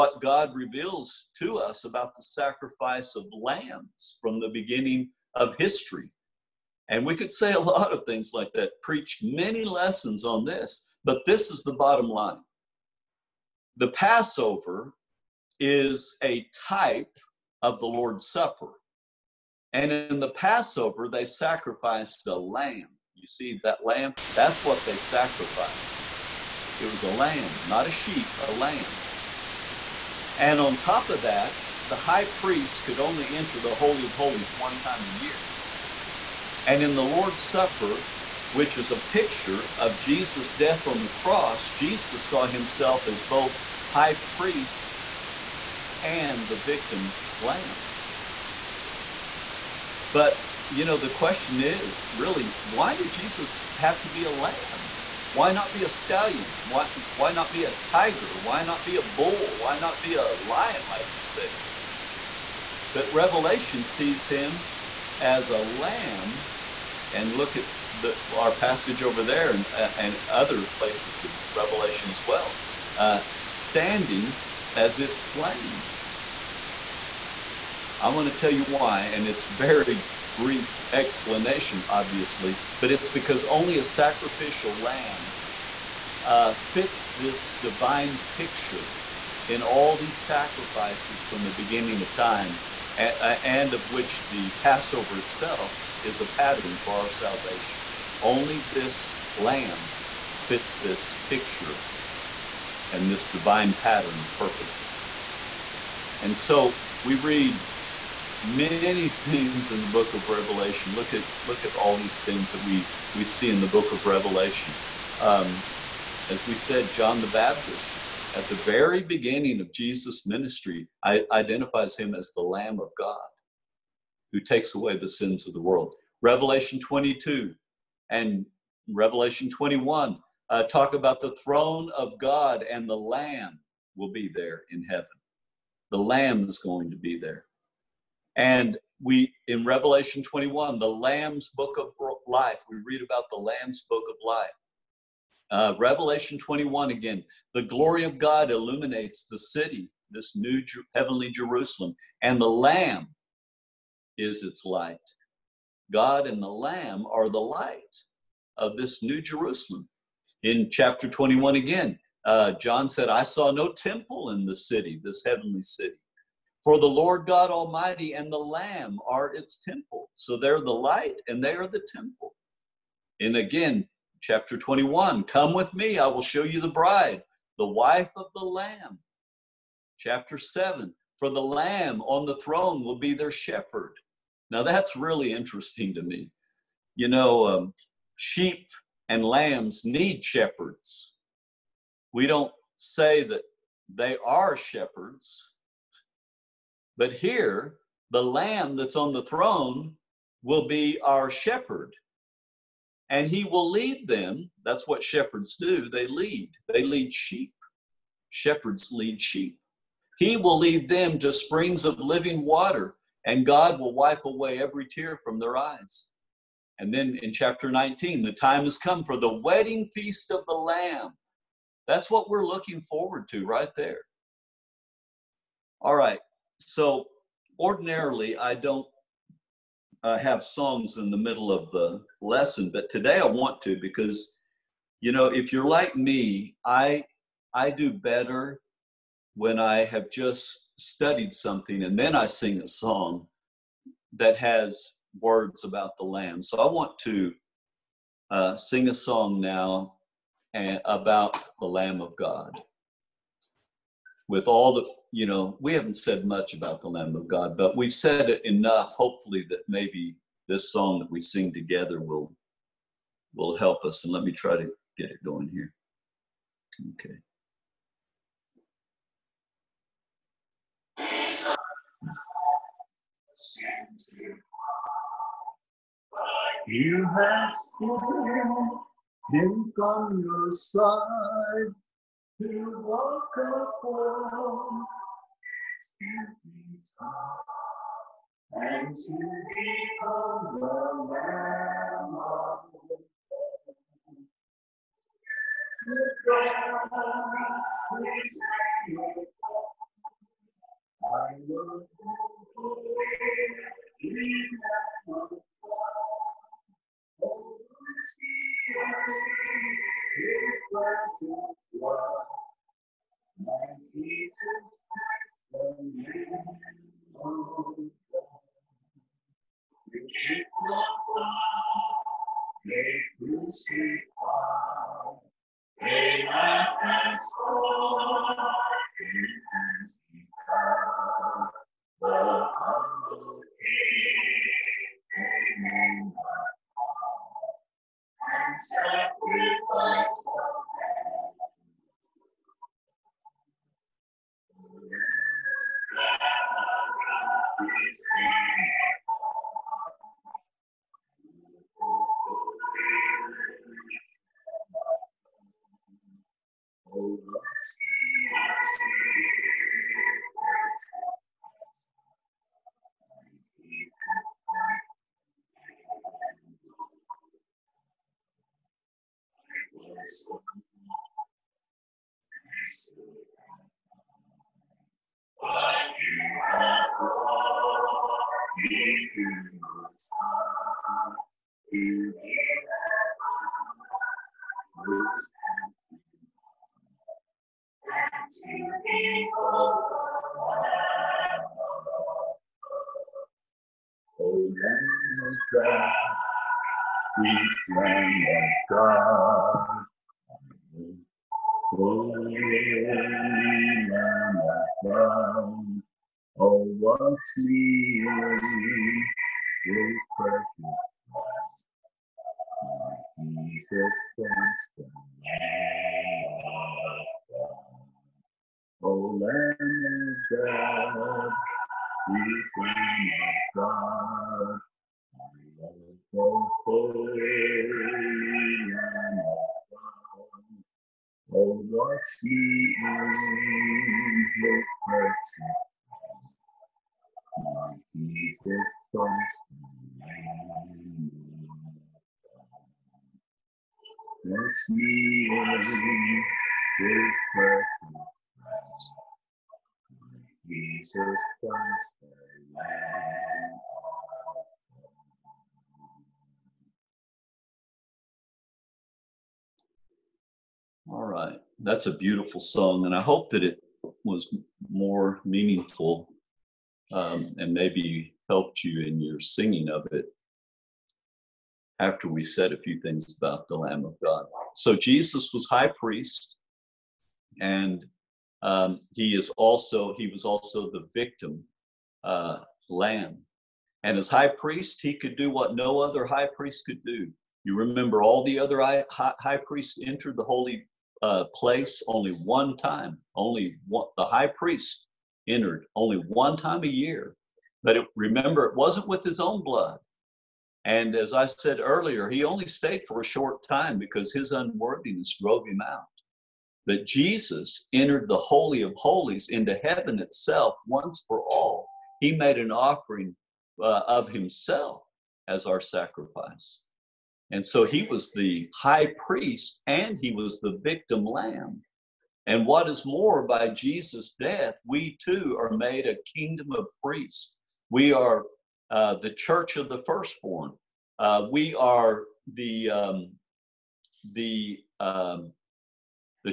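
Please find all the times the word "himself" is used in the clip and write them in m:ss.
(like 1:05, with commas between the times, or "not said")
0:42, 8:34.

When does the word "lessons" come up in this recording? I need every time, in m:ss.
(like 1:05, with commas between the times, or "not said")
0:09, 3:52.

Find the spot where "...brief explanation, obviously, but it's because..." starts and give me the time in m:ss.
1:20.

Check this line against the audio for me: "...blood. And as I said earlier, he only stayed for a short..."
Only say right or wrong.
right.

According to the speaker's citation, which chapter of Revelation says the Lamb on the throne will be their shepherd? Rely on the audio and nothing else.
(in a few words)
Chapter 7.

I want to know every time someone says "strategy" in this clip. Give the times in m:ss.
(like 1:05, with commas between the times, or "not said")
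not said.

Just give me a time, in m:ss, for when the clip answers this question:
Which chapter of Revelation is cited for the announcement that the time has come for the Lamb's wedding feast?
3:37.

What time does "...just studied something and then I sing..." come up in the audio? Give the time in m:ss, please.
4:00.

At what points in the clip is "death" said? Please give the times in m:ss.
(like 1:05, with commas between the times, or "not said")
0:40, 8:44.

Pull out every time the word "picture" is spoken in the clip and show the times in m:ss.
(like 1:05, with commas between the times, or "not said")
0:39, 1:28, 1:41.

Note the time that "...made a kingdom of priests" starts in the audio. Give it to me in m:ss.
8:45.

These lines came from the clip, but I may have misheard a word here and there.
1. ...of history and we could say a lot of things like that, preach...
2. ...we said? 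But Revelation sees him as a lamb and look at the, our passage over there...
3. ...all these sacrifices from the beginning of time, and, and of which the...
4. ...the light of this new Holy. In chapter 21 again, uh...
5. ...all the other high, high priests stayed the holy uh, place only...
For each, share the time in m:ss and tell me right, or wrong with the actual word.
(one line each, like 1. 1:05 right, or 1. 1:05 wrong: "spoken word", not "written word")
1. 0:05 right
2. 1:01 right
3. 1:29 right
4. 2:37 wrong: "Jerusalem", not "Holy"
5. 8:08 wrong: "entered", not "stayed".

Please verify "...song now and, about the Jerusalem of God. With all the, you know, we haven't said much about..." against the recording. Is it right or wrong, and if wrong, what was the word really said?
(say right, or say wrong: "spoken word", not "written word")
wrong: "Lamb", not "Jerusalem".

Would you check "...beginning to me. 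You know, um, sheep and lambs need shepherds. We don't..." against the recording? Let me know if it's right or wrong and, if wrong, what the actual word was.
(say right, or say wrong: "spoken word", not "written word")
wrong: "interesting", not "beginning".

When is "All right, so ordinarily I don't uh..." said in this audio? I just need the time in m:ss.
3:45.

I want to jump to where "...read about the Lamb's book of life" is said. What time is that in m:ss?
2:22.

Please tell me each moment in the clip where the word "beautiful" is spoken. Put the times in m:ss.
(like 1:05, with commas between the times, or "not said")
7:41.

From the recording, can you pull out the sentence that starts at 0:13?
The Passover is a type of the Lord's Supper.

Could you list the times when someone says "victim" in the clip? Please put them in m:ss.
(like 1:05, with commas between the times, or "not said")
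0:46, 8:00, 8:40.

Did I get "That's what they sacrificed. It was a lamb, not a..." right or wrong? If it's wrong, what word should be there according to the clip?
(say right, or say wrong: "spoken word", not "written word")
right.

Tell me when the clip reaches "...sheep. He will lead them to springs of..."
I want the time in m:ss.
3:29.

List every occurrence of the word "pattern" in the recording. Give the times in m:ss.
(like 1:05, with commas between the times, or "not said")
1:36, 1:43.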